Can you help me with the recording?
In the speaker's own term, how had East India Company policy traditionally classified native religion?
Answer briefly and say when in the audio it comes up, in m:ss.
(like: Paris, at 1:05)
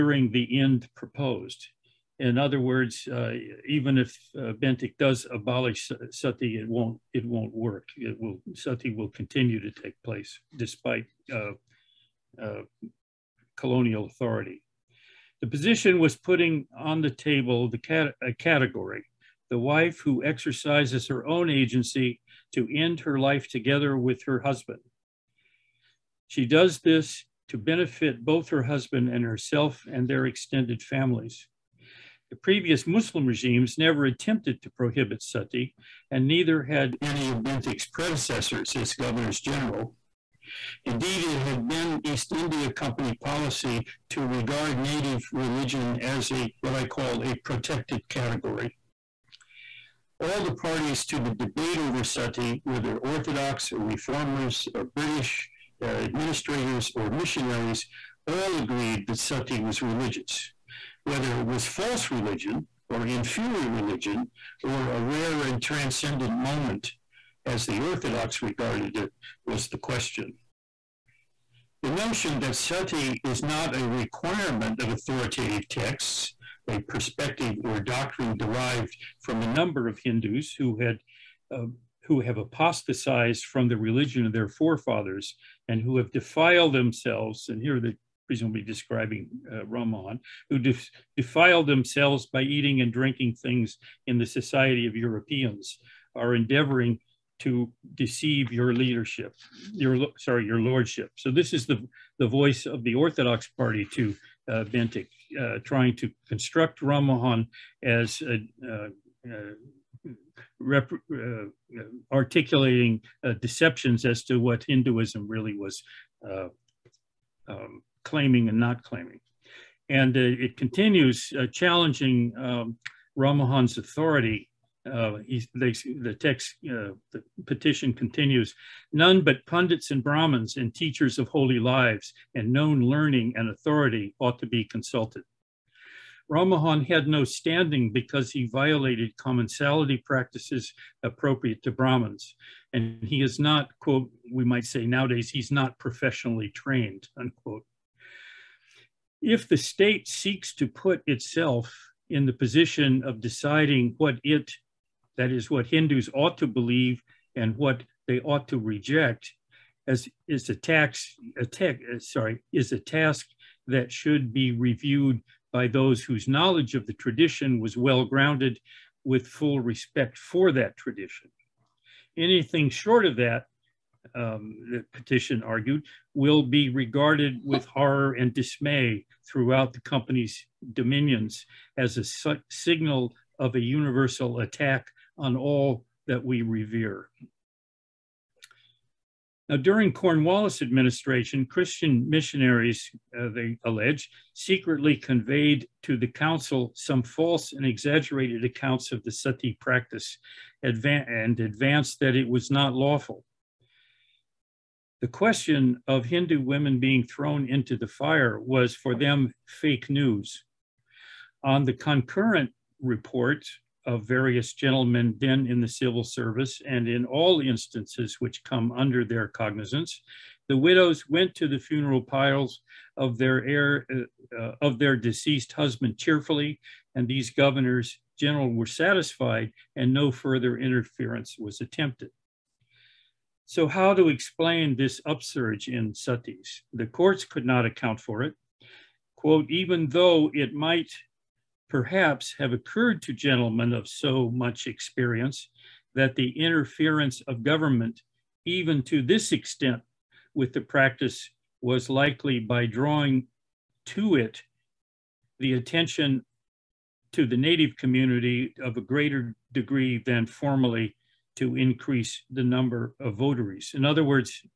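a protected category, at 0:47.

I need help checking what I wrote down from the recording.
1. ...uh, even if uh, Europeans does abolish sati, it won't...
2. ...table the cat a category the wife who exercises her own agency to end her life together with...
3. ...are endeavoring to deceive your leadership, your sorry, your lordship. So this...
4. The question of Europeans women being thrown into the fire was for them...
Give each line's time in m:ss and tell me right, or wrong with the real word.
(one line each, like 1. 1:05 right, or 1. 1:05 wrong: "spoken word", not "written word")
1. 0:03 wrong: "Bentinck", not "Europeans"
2. 0:17 right
3. 1:36 right
4. 3:25 wrong: "Hindu", not "Europeans".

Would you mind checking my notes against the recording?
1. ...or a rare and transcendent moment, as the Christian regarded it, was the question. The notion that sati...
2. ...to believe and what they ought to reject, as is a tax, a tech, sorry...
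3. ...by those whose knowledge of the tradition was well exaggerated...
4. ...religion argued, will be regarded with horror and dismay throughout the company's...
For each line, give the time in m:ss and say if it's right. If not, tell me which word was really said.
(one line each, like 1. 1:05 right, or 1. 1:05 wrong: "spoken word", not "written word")
1. 1:04 wrong: "Orthodox", not "Christian"
2. 2:36 right
3. 2:45 wrong: "grounded", not "exaggerated"
4. 2:54 wrong: "petition", not "religion".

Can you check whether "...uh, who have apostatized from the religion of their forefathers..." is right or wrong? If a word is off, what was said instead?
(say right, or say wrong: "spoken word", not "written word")
right.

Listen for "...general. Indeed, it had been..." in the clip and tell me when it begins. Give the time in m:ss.
0:39.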